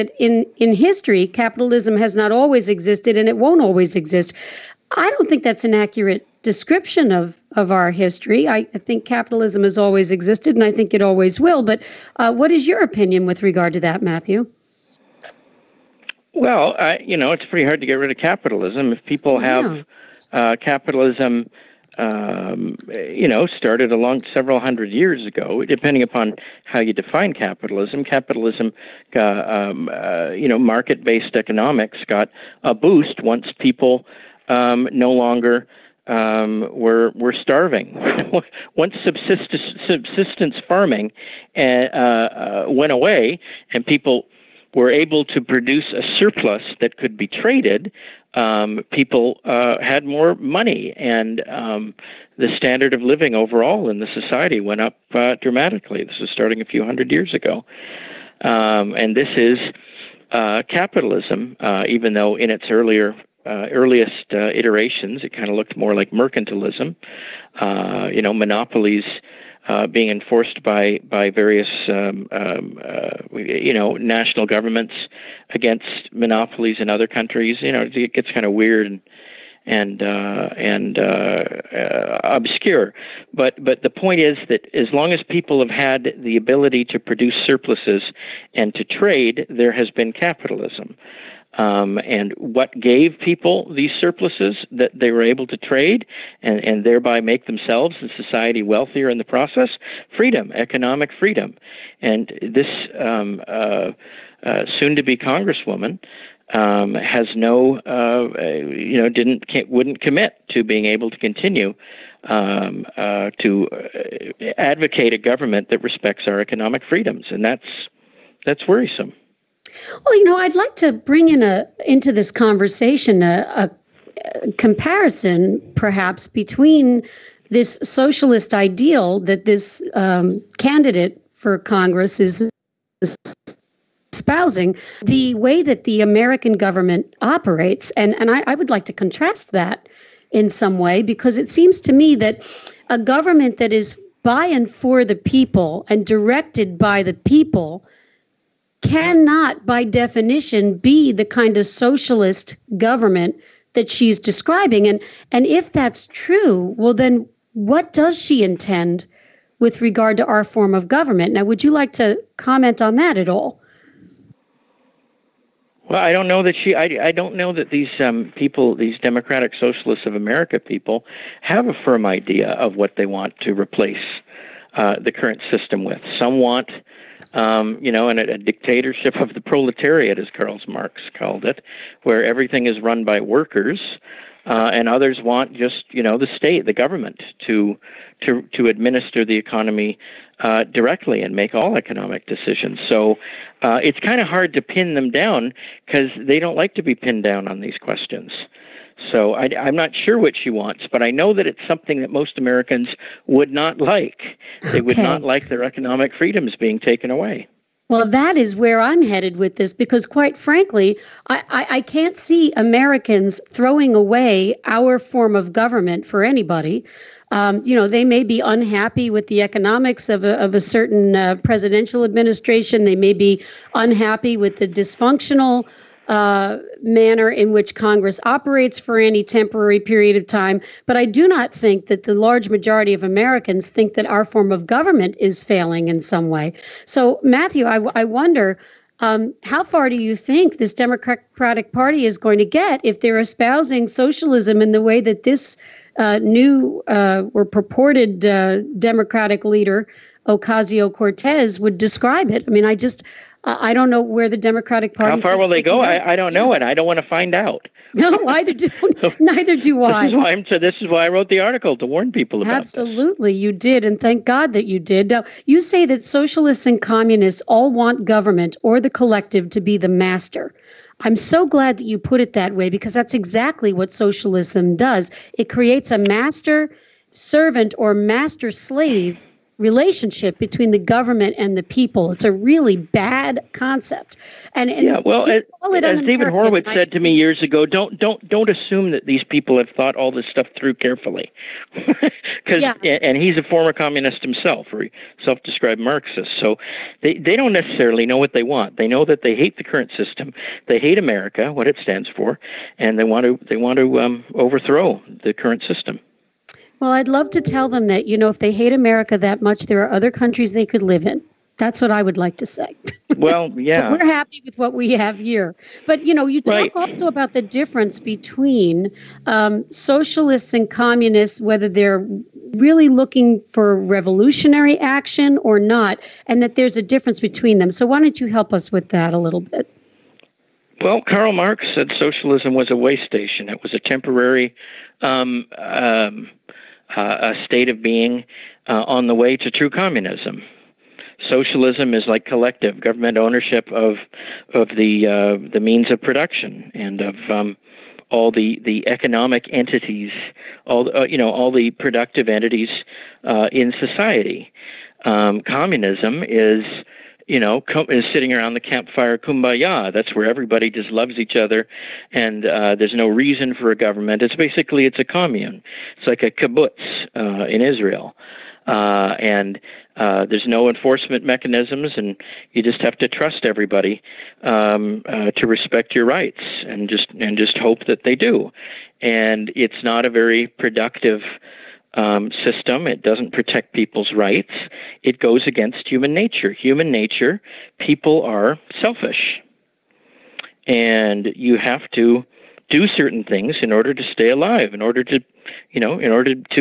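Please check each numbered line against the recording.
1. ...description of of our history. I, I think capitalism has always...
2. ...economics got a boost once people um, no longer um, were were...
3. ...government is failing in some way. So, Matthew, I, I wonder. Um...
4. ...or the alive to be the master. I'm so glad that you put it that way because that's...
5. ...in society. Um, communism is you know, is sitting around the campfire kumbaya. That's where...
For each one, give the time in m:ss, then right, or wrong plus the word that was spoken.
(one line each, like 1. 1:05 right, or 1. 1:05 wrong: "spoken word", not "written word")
1. 0:06 right
2. 0:31 right
3. 3:54 right
4. 4:28 wrong: "collective", not "alive"
5. 5:53 right.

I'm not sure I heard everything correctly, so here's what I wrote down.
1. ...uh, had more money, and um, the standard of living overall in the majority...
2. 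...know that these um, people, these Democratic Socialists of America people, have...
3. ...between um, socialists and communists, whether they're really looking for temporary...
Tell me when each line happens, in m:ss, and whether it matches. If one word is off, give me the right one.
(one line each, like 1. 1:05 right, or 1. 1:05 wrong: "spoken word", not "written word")
1. 0:49 wrong: "society", not "majority"
2. 2:47 right
3. 5:17 wrong: "revolutionary", not "temporary".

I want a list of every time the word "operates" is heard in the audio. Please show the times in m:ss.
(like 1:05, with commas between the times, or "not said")
2:17, 3:48.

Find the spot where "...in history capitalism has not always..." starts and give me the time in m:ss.
0:00.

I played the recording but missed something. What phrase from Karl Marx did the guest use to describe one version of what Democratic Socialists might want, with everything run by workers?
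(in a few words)
Dictatorship of the proletariat.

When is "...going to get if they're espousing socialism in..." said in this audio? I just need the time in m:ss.
4:02.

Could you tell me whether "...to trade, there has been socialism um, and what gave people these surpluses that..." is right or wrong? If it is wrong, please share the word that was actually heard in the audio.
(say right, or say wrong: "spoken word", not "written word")
wrong: "capitalism", not "socialism".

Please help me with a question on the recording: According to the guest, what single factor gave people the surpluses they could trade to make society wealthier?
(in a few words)
Economic freedom.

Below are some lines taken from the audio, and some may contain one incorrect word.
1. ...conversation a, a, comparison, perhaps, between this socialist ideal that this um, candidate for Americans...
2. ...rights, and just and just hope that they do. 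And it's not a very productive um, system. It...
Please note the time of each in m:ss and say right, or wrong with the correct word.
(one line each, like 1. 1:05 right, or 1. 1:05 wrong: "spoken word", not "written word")
1. 2:02 wrong: "Congress", not "Americans"
2. 6:16 right.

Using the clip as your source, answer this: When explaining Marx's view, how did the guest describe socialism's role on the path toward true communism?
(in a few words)
A way station.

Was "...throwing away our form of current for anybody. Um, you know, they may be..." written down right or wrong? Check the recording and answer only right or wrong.
wrong.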